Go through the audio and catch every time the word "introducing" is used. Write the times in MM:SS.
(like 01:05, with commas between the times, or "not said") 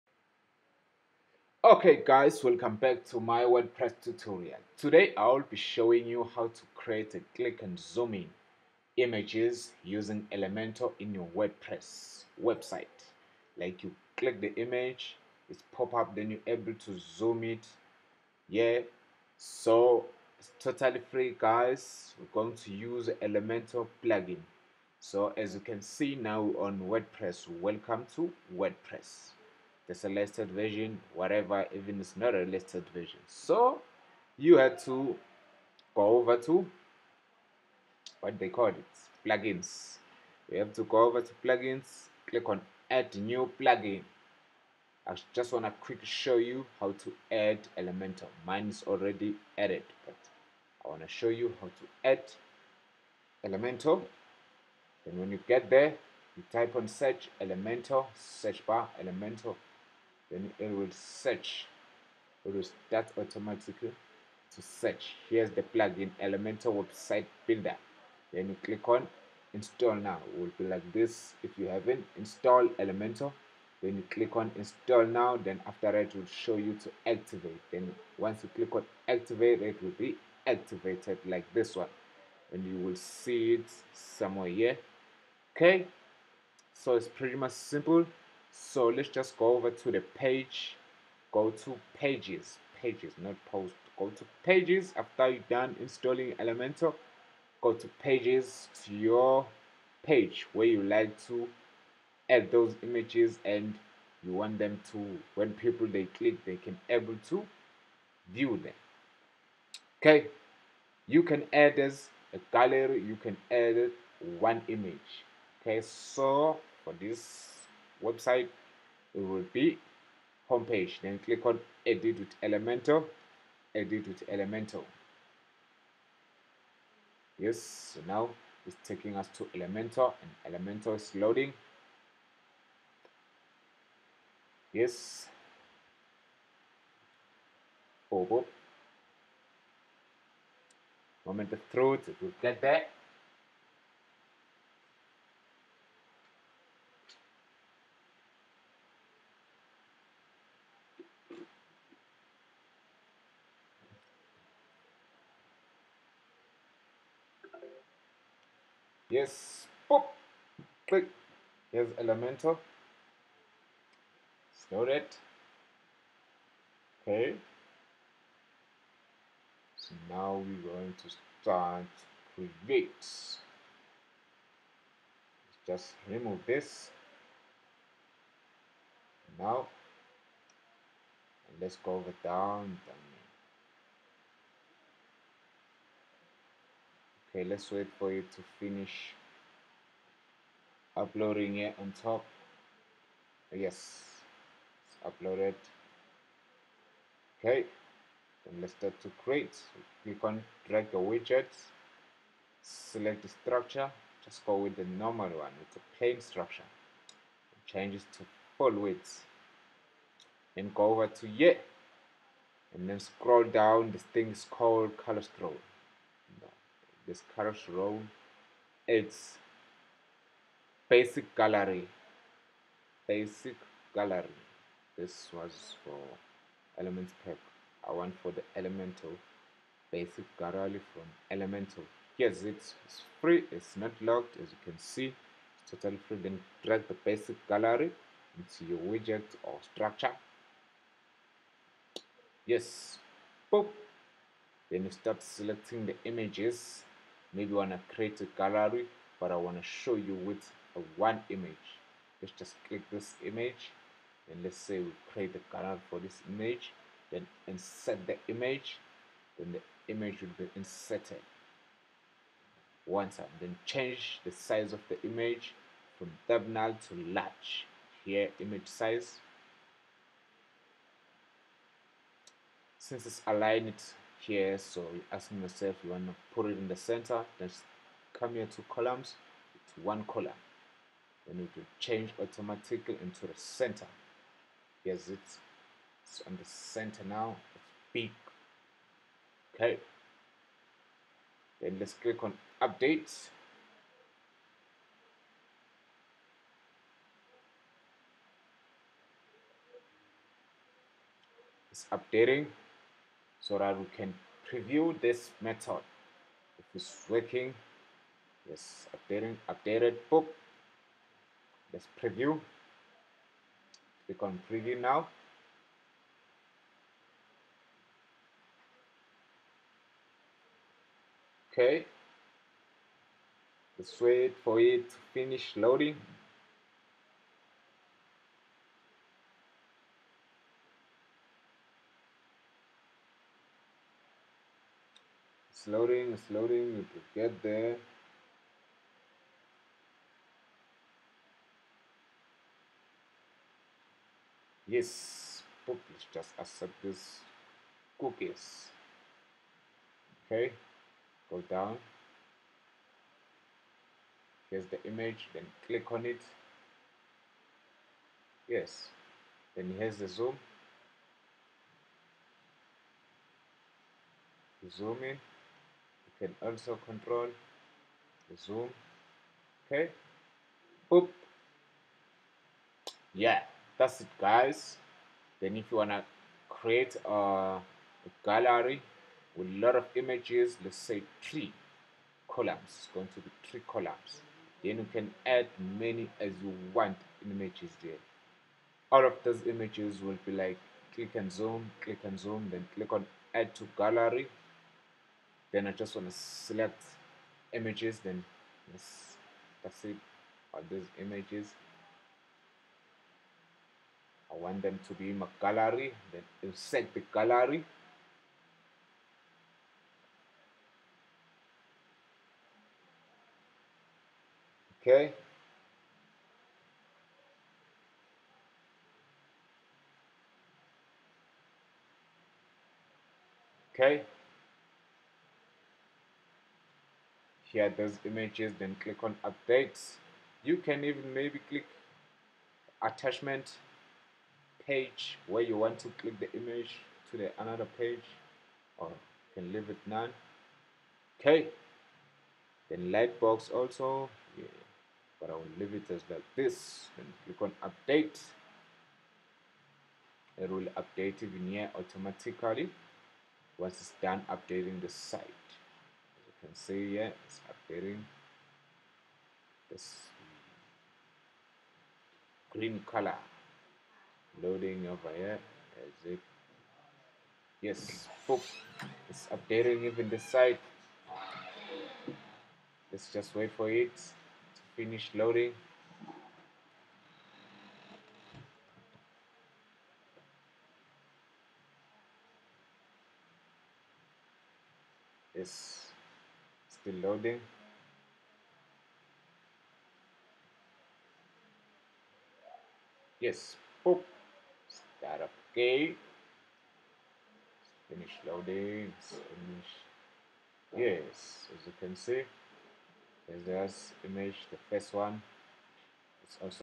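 not said.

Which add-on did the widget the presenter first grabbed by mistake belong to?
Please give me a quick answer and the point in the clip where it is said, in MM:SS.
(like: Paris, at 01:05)
Elements pack, at 03:46.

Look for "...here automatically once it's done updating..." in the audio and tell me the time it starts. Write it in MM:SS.
07:31.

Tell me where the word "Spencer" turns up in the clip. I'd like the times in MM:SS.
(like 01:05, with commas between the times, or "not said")
not said.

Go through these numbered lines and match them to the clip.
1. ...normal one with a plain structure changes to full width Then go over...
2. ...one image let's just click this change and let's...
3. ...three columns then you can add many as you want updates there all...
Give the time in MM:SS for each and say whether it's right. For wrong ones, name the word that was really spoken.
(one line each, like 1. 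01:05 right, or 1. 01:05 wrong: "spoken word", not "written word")
1. 03:24 right
2. 04:10 wrong: "image", not "change"
3. 06:23 wrong: "images", not "updates".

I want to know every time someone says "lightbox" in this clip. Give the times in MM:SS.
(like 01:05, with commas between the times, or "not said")
07:22.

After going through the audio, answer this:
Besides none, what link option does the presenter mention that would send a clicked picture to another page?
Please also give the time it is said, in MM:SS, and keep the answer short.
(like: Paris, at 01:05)
Attachment page, at 07:12.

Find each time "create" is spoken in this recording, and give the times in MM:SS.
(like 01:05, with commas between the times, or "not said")
00:06, 02:52, 03:19, 04:07, 04:15, 06:16.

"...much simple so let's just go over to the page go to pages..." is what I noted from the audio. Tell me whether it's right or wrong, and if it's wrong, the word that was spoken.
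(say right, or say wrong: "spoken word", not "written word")
right.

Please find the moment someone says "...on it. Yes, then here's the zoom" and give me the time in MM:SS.
05:55.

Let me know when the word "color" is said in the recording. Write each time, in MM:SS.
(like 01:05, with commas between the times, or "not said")
03:34, 07:42.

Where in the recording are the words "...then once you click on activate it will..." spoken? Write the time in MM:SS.
01:17.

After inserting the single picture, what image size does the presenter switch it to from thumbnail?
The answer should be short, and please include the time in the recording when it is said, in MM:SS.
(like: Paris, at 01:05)
Large, at 04:26.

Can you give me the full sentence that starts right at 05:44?
Yes, Pop, let's just accept this cookies.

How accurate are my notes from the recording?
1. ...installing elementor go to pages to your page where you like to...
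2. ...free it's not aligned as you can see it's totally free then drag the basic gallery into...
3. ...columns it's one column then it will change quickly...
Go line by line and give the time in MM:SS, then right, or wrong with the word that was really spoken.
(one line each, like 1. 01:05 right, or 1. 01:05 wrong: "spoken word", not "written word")
1. 01:35 right
2. 03:53 wrong: "locked", not "aligned"
3. 04:38 wrong: "automatically", not "quickly".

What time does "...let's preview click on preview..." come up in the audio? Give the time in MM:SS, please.
05:11.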